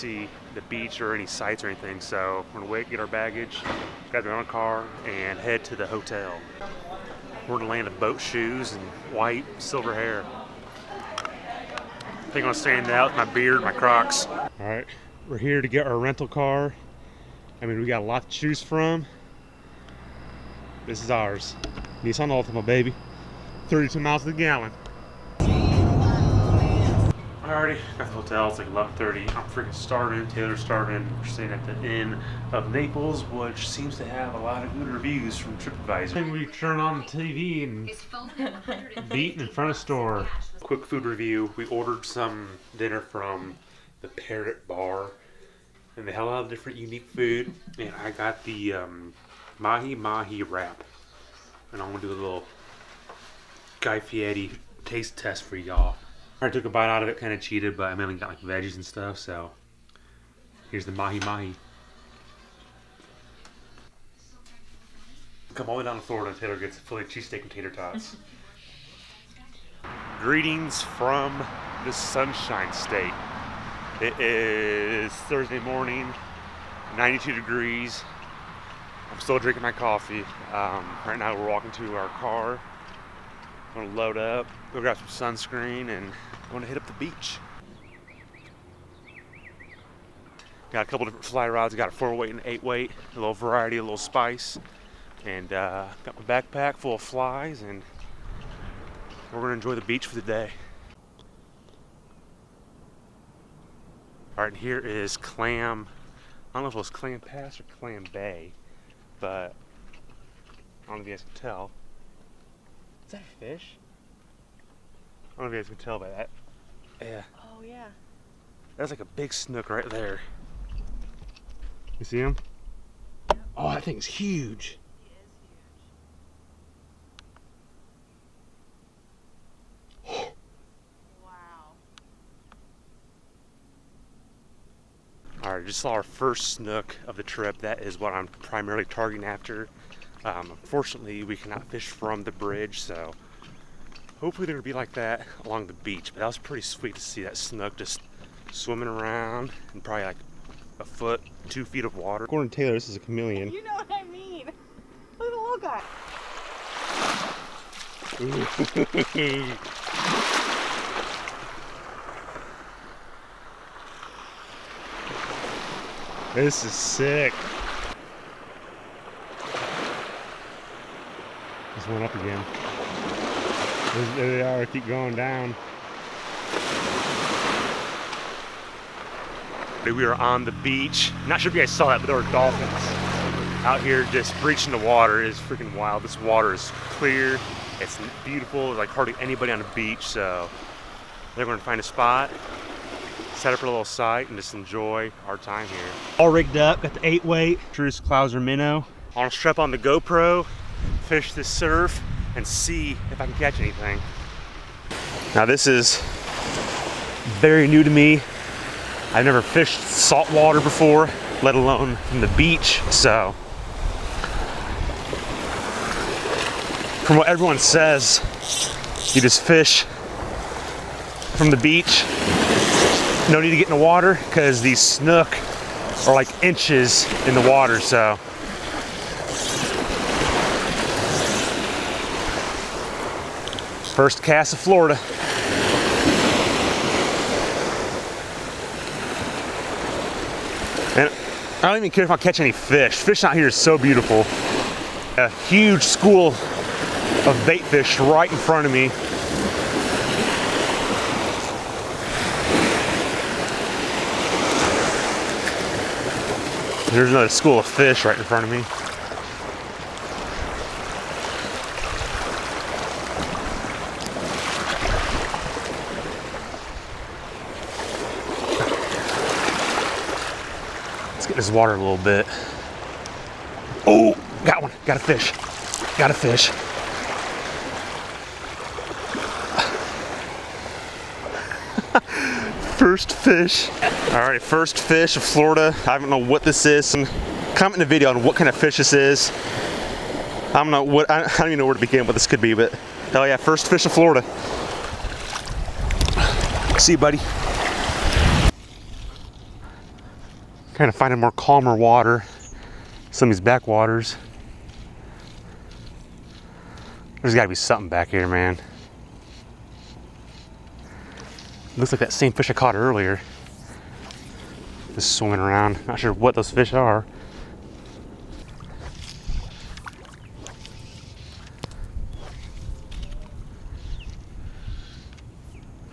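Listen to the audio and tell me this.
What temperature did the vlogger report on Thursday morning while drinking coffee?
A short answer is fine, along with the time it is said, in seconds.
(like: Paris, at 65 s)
92 degrees, at 76 s.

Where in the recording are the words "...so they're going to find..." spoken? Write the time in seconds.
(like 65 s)
190 s.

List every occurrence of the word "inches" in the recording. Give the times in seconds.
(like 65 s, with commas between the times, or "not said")
226 s.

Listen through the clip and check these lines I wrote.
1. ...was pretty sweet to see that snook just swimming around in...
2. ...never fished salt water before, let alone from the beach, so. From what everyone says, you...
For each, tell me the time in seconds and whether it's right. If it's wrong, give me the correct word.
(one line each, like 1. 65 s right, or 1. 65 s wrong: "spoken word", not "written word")
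1. 146 s right
2. 209 s right.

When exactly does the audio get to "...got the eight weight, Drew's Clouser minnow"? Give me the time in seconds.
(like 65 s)
196 s.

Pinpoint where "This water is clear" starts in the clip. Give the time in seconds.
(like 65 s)
186 s.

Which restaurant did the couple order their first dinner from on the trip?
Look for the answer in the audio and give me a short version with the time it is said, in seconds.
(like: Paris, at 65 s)
Parrot Bar, at 44 s.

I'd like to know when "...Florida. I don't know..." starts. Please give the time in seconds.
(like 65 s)
285 s.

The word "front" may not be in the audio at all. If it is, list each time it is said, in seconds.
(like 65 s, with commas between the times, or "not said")
39 s, 248 s, 258 s.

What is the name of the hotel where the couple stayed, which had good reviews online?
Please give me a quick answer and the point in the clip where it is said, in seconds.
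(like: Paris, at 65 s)
Inn of Naples, at 31 s.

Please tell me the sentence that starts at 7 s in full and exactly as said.
We're in the land of boat shoes and white, silver hair.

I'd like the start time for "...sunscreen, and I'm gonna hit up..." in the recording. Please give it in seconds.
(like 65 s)
85 s.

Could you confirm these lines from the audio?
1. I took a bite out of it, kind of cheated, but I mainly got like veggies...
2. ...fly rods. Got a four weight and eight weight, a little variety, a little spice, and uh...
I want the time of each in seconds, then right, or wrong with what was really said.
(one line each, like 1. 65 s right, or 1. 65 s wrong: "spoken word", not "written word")
1. 56 s right
2. 91 s right.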